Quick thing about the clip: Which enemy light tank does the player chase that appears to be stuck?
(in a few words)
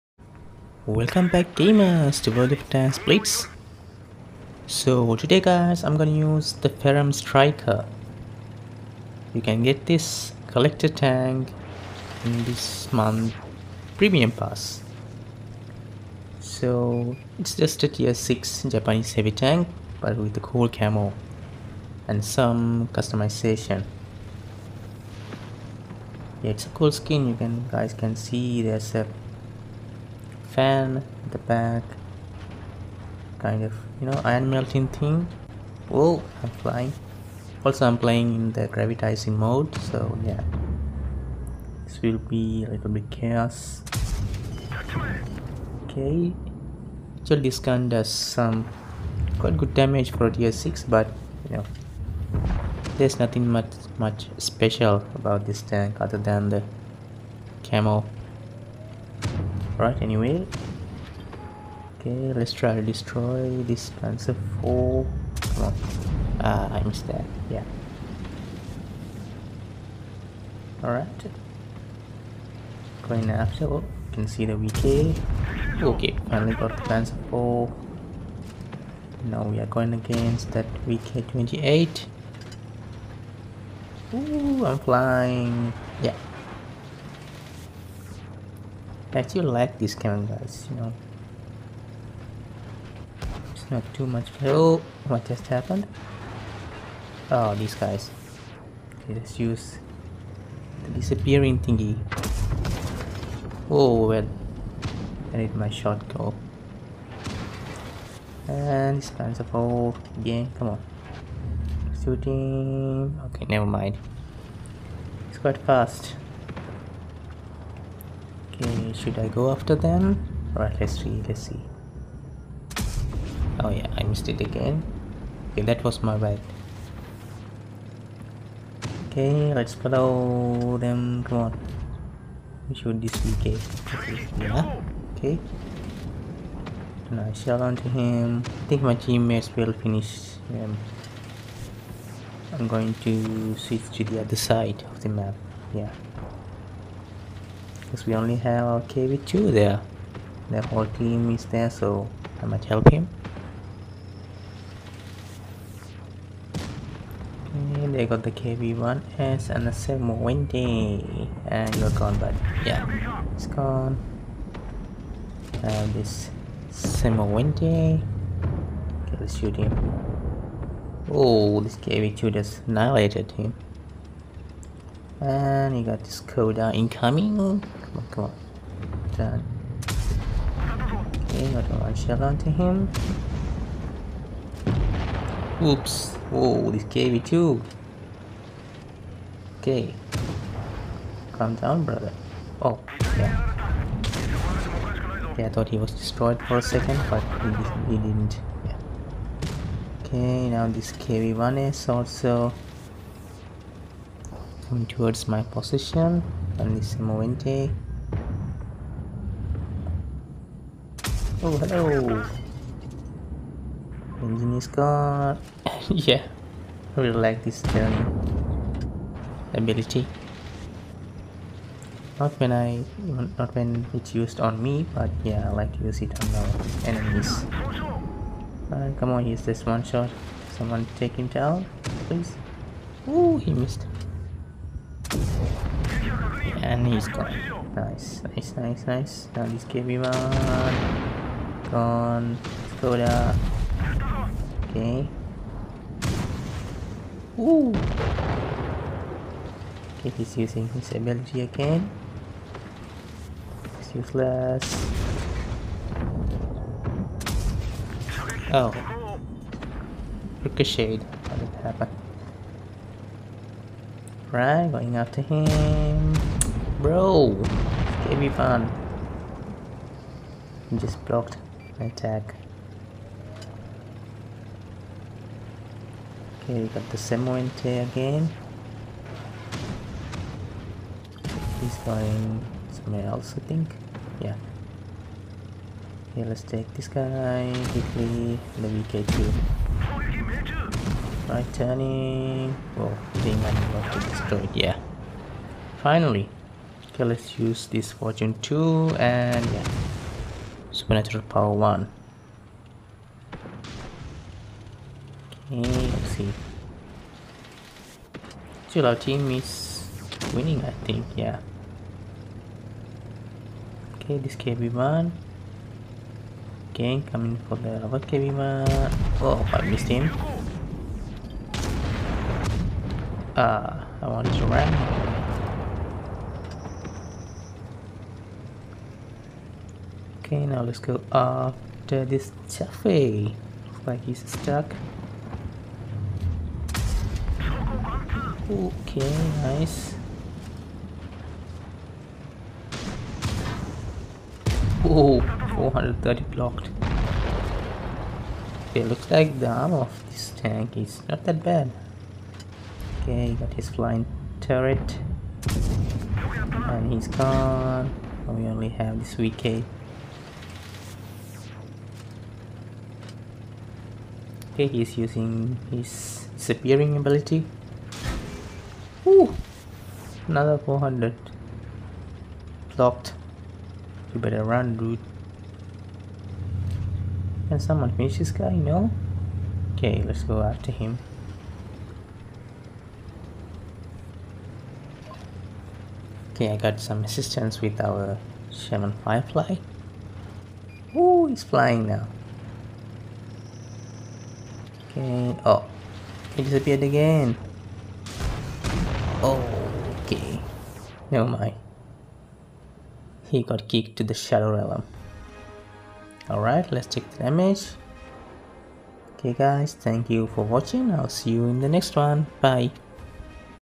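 Chaffee.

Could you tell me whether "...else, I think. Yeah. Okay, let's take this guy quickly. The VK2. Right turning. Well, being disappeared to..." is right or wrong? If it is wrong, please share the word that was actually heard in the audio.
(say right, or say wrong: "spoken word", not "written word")
wrong: "managed", not "disappeared".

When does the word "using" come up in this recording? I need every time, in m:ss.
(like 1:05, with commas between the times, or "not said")
4:10, 6:04.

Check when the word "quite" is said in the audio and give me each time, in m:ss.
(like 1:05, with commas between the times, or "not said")
0:49, 1:55.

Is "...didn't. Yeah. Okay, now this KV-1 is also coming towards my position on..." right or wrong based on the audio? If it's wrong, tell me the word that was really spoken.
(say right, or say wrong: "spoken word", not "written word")
right.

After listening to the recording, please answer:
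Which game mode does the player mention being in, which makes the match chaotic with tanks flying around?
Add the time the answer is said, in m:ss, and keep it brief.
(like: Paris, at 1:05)
Gravitizing mode, at 0:38.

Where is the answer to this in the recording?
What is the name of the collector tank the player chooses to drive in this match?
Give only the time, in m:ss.
0:06.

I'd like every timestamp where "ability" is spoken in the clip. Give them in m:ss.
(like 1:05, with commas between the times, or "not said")
3:39, 4:10, 6:06.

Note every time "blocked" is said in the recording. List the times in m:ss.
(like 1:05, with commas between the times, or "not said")
4:31, 5:46, 6:12.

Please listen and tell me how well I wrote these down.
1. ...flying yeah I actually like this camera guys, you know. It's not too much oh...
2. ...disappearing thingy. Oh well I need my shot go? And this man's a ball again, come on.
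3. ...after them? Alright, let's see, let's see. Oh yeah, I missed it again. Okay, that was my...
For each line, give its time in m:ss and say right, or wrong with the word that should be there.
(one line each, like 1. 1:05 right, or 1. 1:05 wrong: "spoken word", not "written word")
1. 1:24 right
2. 1:40 right
3. 1:59 right.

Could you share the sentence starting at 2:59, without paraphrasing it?
Okay, how do I shell onto him?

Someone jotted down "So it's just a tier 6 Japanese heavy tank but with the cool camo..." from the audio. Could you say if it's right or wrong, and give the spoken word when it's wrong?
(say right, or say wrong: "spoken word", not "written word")
right.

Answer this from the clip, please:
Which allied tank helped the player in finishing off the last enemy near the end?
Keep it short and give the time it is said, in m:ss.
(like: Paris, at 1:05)
Sherman Firefly, at 6:28.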